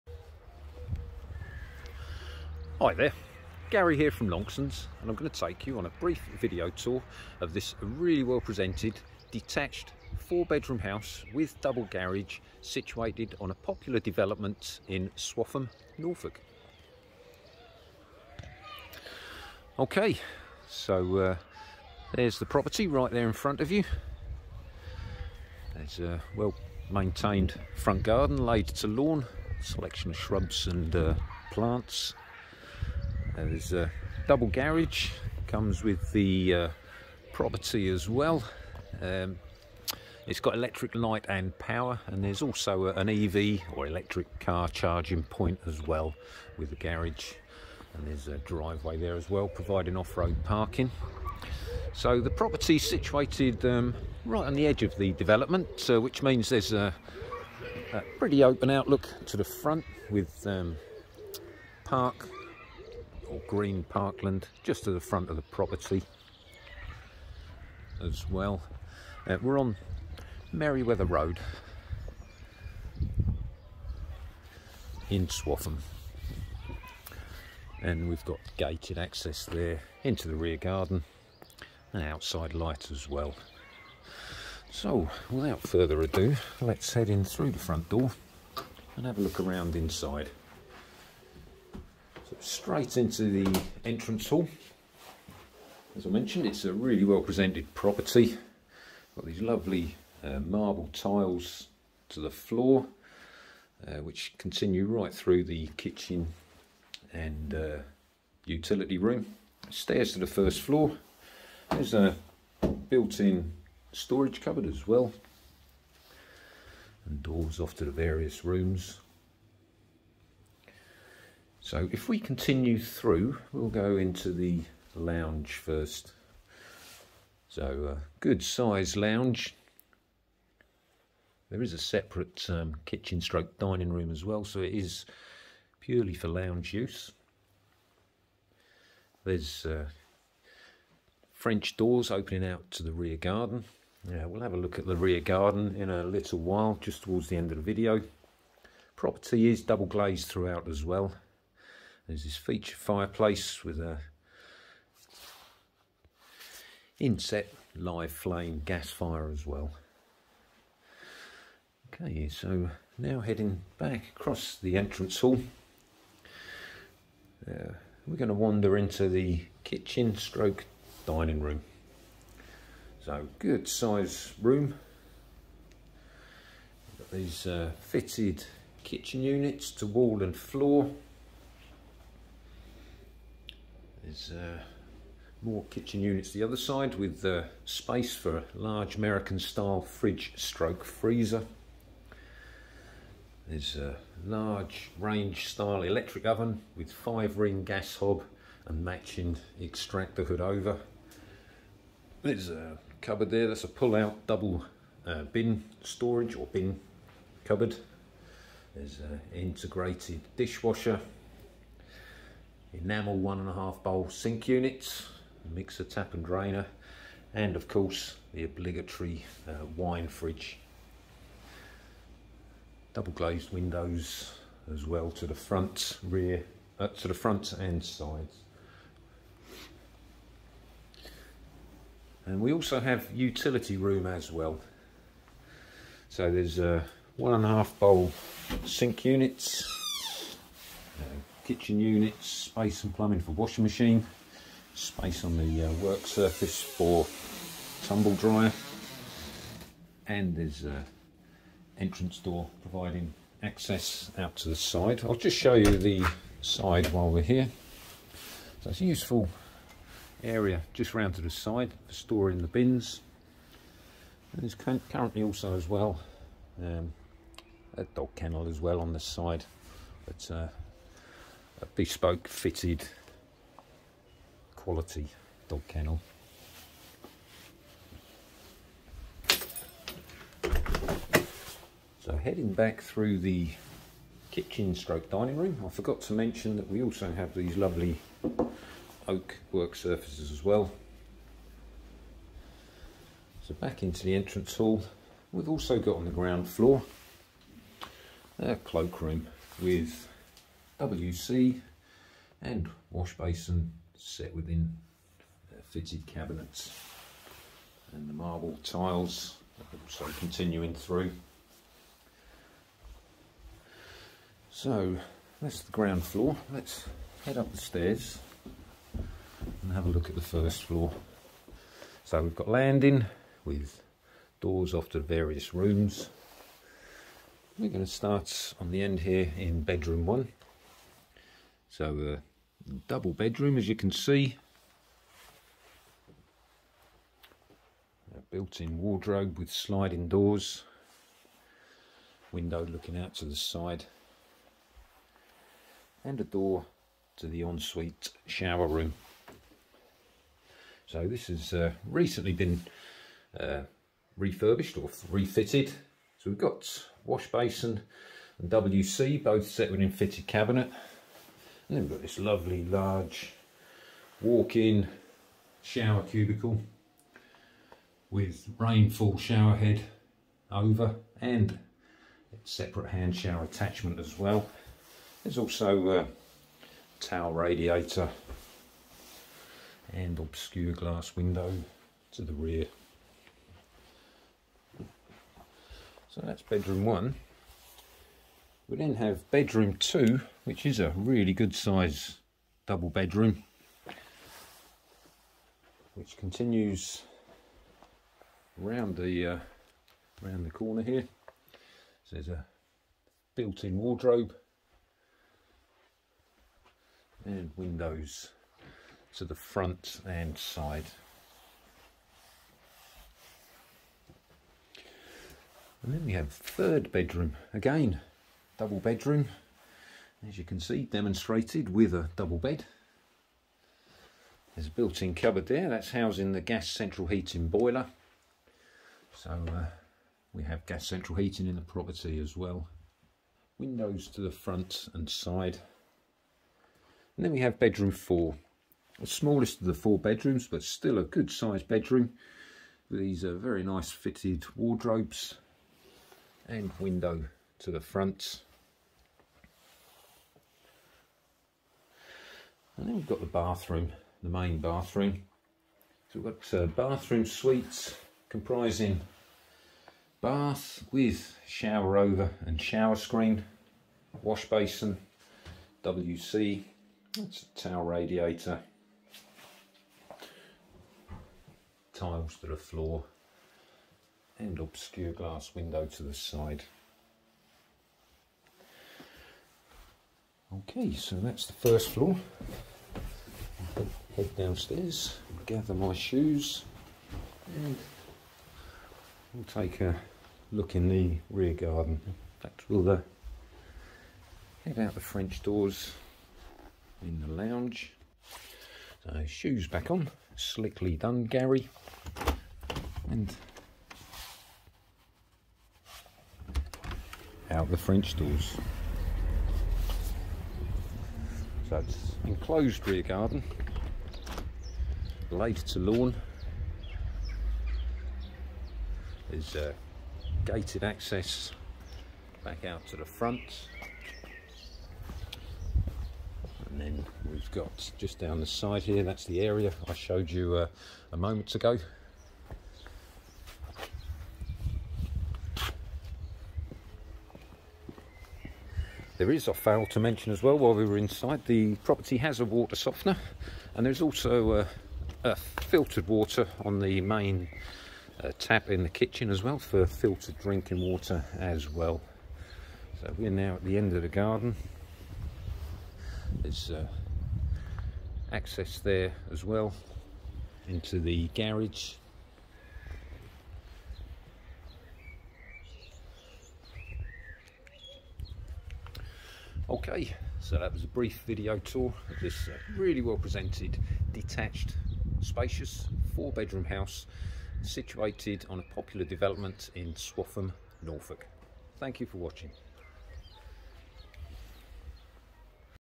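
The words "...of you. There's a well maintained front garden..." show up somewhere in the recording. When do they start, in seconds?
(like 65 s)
23 s.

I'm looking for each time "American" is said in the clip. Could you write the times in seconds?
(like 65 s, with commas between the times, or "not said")
188 s.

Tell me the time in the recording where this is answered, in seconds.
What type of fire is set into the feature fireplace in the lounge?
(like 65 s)
157 s.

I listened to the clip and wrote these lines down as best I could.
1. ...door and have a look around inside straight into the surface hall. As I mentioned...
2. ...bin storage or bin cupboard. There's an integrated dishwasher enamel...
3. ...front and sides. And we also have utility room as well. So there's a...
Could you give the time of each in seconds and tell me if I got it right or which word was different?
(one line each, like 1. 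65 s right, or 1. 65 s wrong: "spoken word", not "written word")
1. 87 s wrong: "entrance", not "surface"
2. 205 s right
3. 227 s right.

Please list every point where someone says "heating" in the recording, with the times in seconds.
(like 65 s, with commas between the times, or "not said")
427 s, 431 s.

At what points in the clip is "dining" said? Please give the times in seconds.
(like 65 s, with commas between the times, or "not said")
133 s, 171 s, 285 s.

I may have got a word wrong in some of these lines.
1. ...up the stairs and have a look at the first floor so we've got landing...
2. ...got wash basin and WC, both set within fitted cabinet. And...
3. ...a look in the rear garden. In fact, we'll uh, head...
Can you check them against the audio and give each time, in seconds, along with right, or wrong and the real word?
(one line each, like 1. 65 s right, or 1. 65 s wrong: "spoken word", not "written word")
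1. 317 s right
2. 356 s right
3. 489 s right.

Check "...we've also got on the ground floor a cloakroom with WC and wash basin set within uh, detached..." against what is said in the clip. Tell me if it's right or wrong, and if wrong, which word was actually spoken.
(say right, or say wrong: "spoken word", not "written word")
wrong: "fitted", not "detached".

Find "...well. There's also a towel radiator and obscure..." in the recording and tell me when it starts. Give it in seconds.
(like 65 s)
374 s.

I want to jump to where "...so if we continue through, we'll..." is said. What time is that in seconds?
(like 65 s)
121 s.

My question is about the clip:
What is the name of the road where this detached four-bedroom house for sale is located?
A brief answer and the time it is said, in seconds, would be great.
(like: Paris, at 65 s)
Merriweather Road, at 70 s.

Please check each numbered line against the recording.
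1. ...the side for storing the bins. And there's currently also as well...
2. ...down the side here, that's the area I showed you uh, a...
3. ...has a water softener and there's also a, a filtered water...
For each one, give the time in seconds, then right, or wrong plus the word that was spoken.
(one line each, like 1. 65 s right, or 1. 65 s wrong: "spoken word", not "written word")
1. 261 s right
2. 528 s right
3. 542 s right.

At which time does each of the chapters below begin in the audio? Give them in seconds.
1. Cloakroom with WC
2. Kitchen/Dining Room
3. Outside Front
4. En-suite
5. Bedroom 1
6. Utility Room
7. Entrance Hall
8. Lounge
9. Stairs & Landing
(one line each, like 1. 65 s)
1. 296 s
2. 165 s
3. 17 s
4. 348 s
5. 328 s
6. 232 s
7. 85 s
8. 123 s
9. 315 s.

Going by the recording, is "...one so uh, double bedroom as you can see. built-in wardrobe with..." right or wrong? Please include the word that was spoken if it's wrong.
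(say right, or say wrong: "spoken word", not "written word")
right.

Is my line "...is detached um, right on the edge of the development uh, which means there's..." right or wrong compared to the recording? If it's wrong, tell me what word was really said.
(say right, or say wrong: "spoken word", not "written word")
wrong: "situated", not "detached".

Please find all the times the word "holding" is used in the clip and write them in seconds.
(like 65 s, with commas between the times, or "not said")
not said.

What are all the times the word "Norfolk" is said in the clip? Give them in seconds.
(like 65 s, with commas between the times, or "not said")
15 s, 580 s.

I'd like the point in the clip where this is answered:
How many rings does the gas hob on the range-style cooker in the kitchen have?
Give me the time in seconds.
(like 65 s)
196 s.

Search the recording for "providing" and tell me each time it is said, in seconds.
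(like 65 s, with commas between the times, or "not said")
49 s, 252 s.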